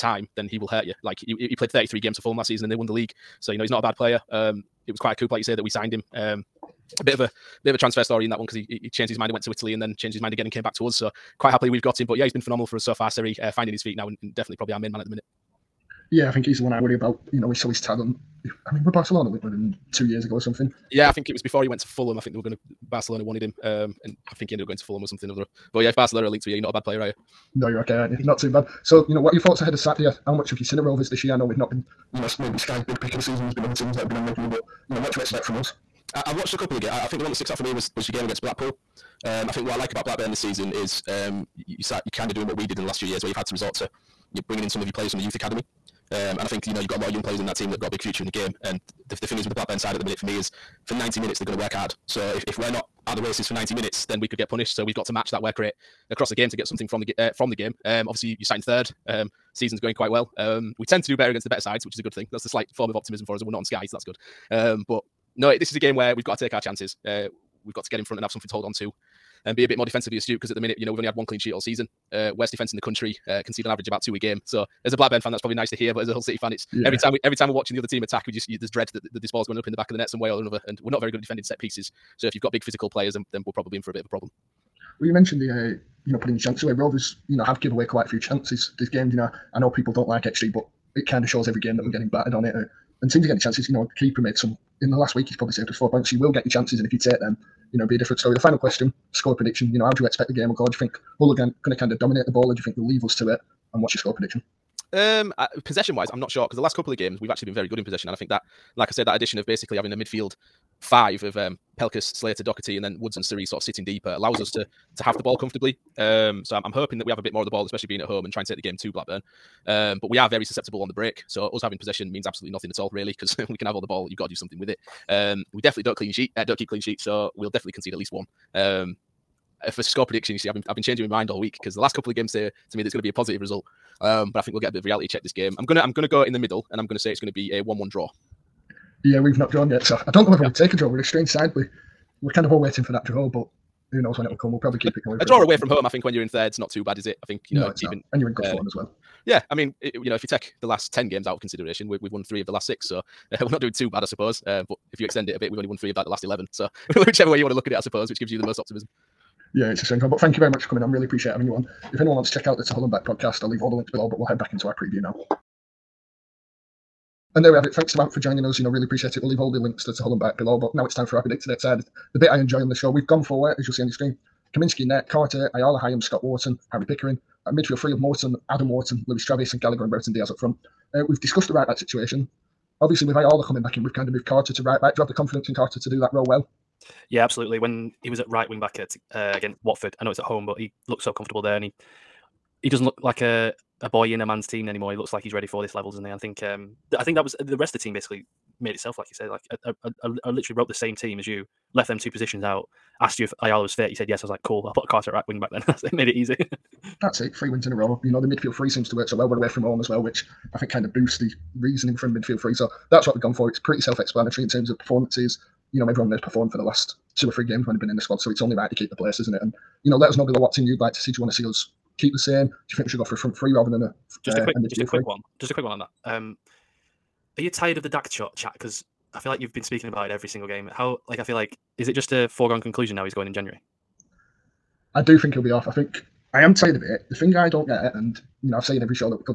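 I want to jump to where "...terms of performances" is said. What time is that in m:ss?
3:34.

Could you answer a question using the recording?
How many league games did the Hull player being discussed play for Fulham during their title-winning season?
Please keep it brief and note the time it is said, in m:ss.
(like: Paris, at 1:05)
33, at 0:01.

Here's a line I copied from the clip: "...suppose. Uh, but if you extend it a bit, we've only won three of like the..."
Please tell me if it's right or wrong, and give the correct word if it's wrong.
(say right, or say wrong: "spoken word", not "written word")
right.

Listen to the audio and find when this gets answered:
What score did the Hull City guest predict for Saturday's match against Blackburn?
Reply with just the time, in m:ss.
2:17.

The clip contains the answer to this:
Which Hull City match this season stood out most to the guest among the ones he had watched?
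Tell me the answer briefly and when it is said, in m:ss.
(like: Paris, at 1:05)
Blackpool, at 0:38.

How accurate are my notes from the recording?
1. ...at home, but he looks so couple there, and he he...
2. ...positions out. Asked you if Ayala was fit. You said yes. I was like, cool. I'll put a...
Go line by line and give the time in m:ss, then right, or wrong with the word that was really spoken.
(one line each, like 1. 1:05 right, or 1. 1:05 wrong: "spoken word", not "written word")
1. 3:10 wrong: "comfortable", not "couple"
2. 3:22 right.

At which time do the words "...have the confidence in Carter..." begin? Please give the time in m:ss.
3:05.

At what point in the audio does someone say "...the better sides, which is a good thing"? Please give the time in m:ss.
1:01.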